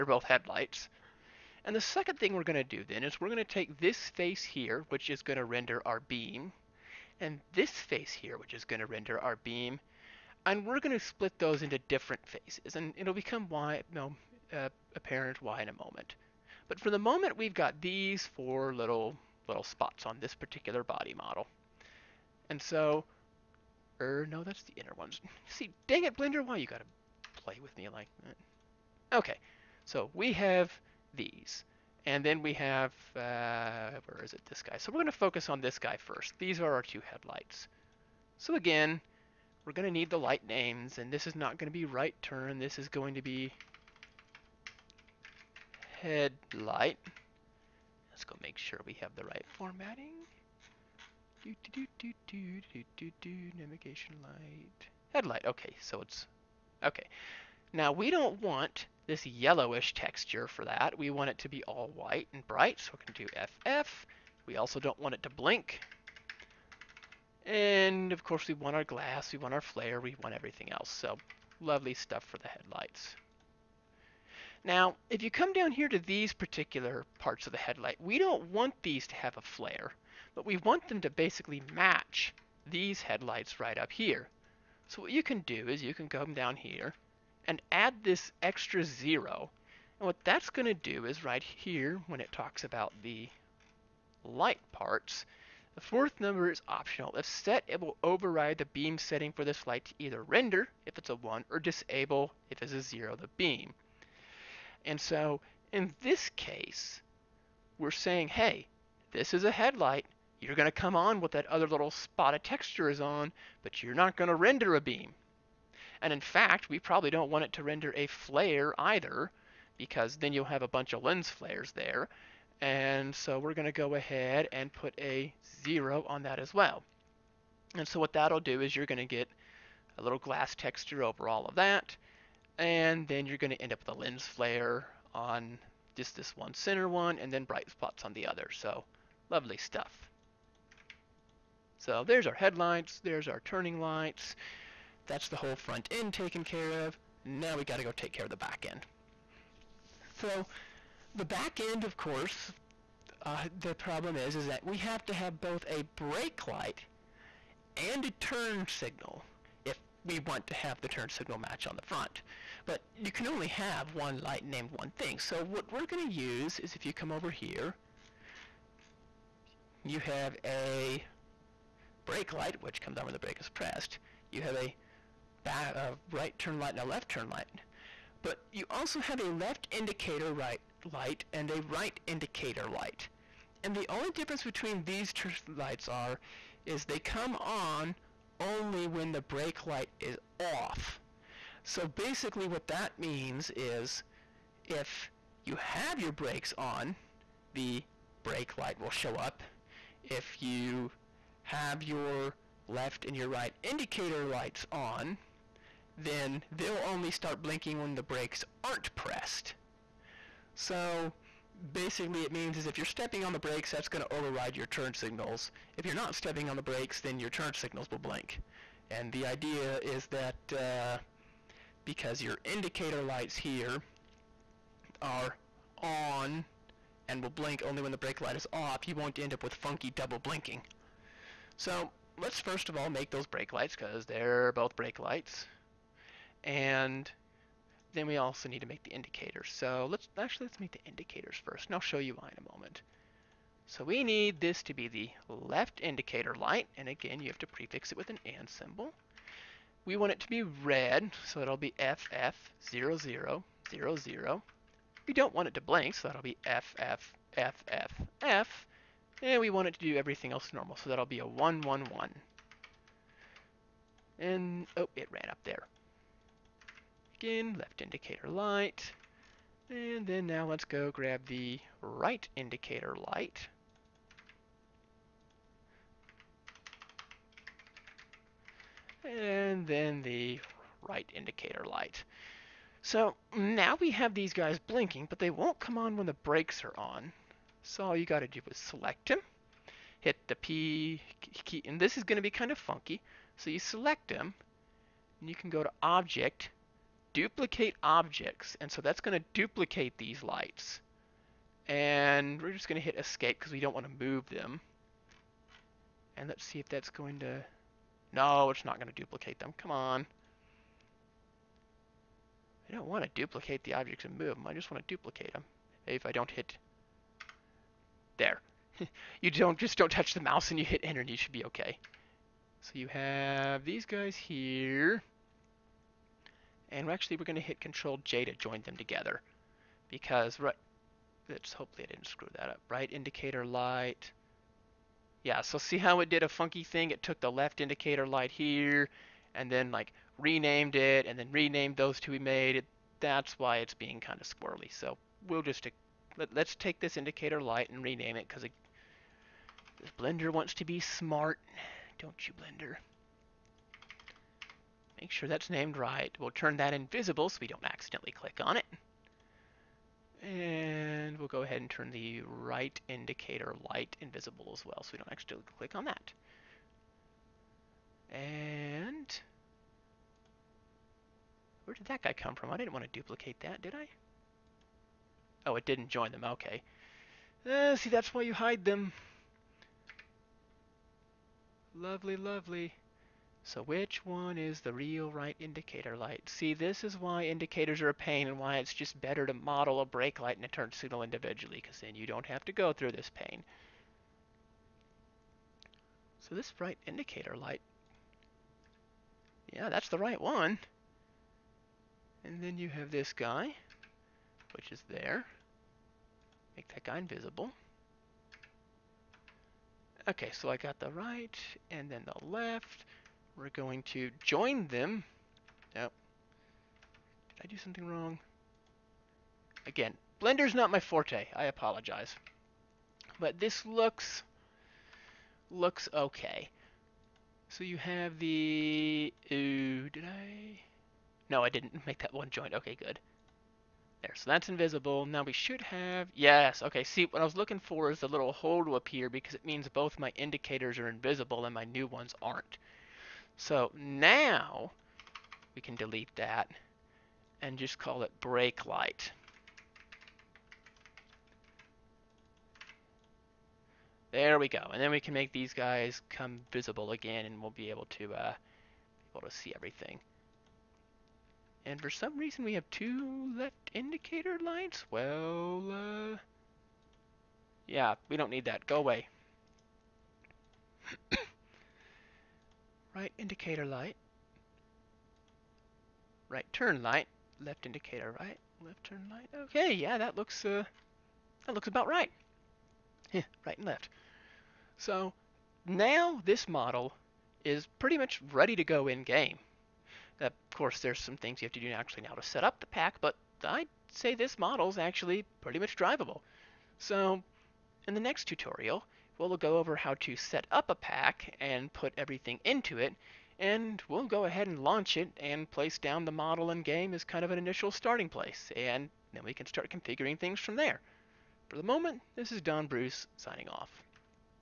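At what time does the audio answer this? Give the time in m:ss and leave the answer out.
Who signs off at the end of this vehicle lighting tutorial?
8:32.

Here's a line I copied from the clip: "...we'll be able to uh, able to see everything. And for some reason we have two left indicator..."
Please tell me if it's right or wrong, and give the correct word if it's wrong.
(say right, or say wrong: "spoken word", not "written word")
right.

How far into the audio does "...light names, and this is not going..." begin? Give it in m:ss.
0:40.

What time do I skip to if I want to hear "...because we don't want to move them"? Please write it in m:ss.
5:03.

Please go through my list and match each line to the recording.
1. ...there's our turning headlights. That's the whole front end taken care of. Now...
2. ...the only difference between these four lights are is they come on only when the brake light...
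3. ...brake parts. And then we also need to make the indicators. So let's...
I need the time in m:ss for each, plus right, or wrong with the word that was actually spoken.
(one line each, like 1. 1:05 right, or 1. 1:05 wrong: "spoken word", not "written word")
1. 2:22 wrong: "lights", not "headlights"
2. 3:03 wrong: "two", not "four"
3. 3:54 wrong: "lights", not "parts".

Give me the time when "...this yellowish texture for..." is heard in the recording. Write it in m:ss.
0:59.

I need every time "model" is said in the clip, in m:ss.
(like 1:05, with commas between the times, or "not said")
0:21, 6:29, 8:06, 8:14, 8:26.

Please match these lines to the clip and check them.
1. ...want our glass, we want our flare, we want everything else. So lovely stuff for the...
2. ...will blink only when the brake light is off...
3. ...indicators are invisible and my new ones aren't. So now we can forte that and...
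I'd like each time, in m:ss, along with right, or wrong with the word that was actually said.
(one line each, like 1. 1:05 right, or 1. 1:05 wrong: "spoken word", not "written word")
1. 1:08 right
2. 3:47 right
3. 7:20 wrong: "delete", not "forte".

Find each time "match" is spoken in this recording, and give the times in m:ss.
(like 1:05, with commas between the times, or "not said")
1:21, 2:41.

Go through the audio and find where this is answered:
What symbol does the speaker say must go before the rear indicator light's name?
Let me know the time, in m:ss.
4:08.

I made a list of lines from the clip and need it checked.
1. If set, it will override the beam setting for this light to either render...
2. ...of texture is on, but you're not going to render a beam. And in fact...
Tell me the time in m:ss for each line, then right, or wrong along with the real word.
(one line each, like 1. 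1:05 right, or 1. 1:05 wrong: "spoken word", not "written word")
1. 1:37 right
2. 1:52 right.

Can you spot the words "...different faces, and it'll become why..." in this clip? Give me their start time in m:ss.
0:11.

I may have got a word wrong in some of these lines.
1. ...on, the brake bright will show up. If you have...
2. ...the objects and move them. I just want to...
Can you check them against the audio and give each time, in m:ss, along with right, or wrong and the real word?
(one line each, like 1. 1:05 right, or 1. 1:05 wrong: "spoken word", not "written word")
1. 3:16 wrong: "light", not "bright"
2. 5:13 right.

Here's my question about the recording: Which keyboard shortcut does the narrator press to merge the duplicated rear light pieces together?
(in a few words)
Control J.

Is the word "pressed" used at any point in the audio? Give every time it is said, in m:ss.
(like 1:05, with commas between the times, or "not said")
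2:53, 3:28.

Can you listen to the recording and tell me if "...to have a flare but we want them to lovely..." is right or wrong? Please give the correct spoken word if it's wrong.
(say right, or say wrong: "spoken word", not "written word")
wrong: "basically", not "lovely".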